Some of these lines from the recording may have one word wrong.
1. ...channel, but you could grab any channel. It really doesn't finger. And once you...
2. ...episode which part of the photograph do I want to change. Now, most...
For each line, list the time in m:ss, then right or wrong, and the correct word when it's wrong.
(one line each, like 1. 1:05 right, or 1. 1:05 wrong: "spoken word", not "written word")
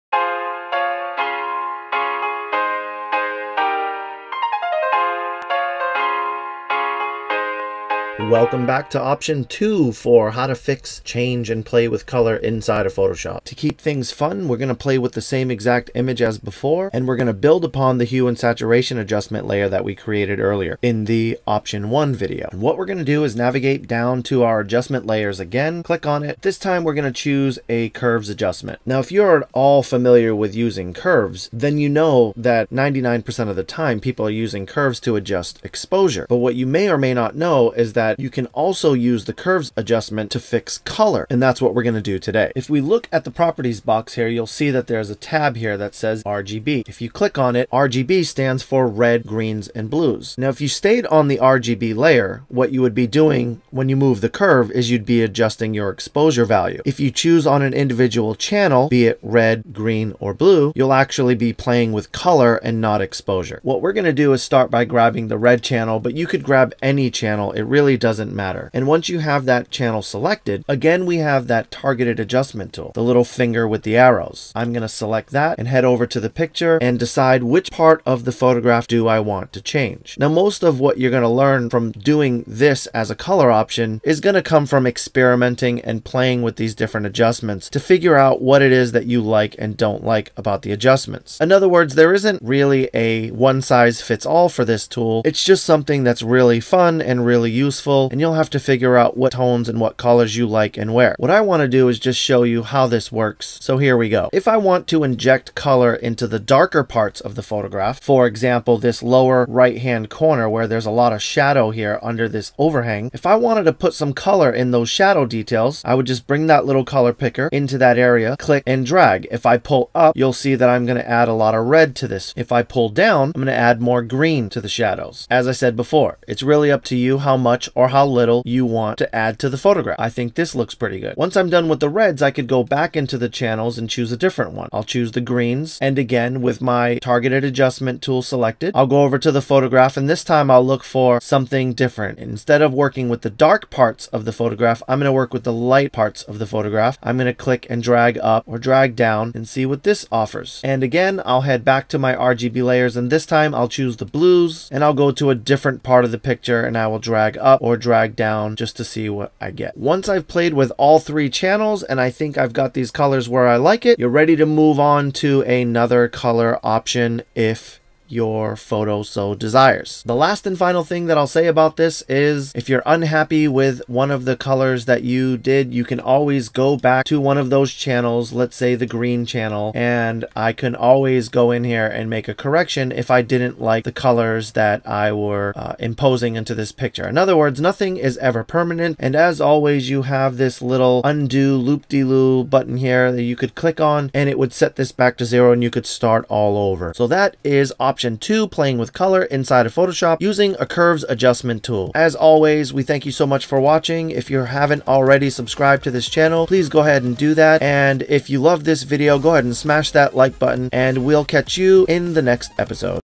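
1. 1:05 wrong: "matter", not "finger"
2. 1:16 wrong: "decide", not "episode".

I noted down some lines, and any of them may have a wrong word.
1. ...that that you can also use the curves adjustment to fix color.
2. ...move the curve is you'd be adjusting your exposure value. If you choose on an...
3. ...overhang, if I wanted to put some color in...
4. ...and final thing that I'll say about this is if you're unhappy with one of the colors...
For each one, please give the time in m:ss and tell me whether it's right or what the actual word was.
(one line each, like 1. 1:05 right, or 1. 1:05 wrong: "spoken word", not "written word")
1. 0:37 right
2. 0:53 right
3. 1:52 right
4. 2:50 right.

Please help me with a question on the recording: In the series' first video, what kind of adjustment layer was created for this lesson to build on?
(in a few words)
Hue and saturation.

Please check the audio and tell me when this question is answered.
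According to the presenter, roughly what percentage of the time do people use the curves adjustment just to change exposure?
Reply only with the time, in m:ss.
0:32.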